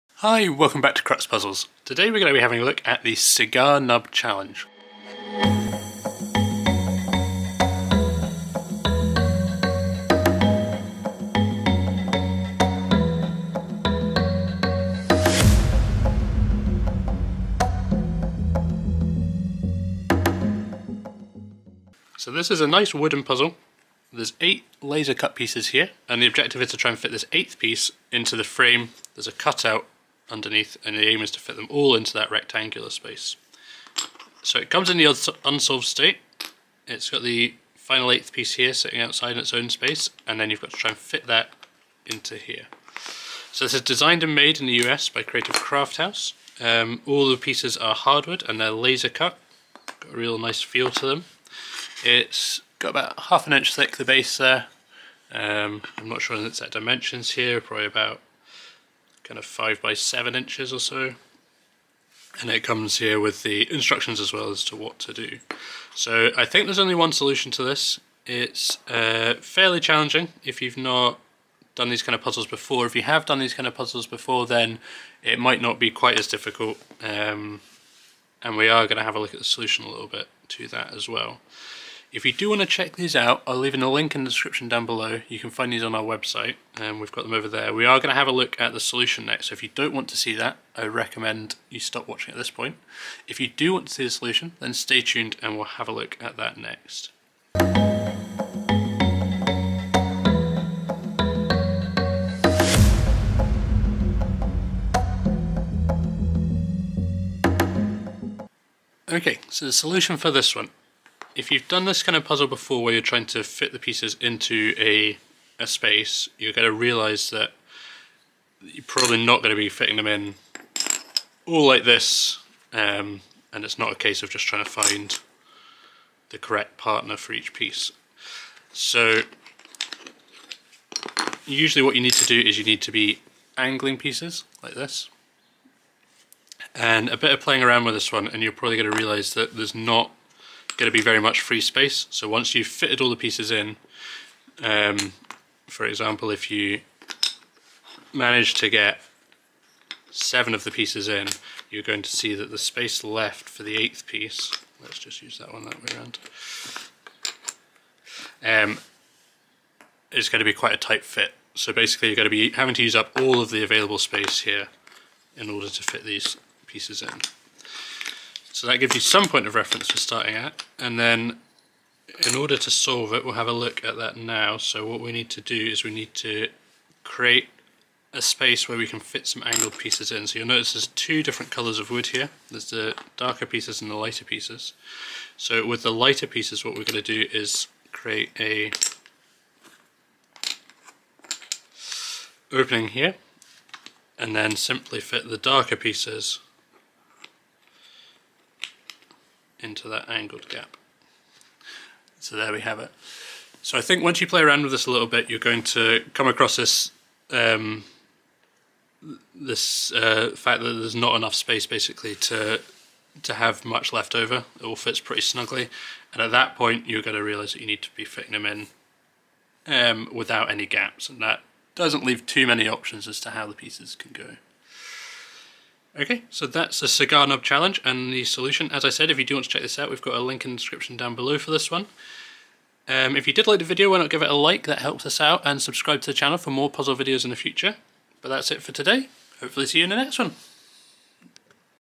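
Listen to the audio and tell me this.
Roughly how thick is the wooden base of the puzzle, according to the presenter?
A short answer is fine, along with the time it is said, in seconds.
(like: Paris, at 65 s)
half an inch, at 53 s.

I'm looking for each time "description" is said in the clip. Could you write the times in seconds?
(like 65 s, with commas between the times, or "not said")
84 s, 230 s.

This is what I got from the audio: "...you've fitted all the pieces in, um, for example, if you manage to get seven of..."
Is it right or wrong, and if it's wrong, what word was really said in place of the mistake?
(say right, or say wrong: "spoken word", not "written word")
right.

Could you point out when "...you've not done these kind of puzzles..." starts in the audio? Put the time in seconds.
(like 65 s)
70 s.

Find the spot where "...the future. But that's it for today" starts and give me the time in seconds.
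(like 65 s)
237 s.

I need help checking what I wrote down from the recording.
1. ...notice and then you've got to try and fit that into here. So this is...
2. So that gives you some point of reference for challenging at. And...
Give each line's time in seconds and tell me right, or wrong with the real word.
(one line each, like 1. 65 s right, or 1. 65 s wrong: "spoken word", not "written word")
1. 39 s wrong: "space", not "notice"
2. 168 s wrong: "starting", not "challenging".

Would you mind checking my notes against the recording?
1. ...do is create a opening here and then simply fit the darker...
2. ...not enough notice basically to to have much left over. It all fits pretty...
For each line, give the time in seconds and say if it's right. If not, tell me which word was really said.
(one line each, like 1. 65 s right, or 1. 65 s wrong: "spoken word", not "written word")
1. 187 s right
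2. 210 s wrong: "space", not "notice".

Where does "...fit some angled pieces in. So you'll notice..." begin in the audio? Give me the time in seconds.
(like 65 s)
178 s.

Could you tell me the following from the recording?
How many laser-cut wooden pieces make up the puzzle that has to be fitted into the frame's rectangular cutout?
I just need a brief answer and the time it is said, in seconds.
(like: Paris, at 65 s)
8, at 24 s.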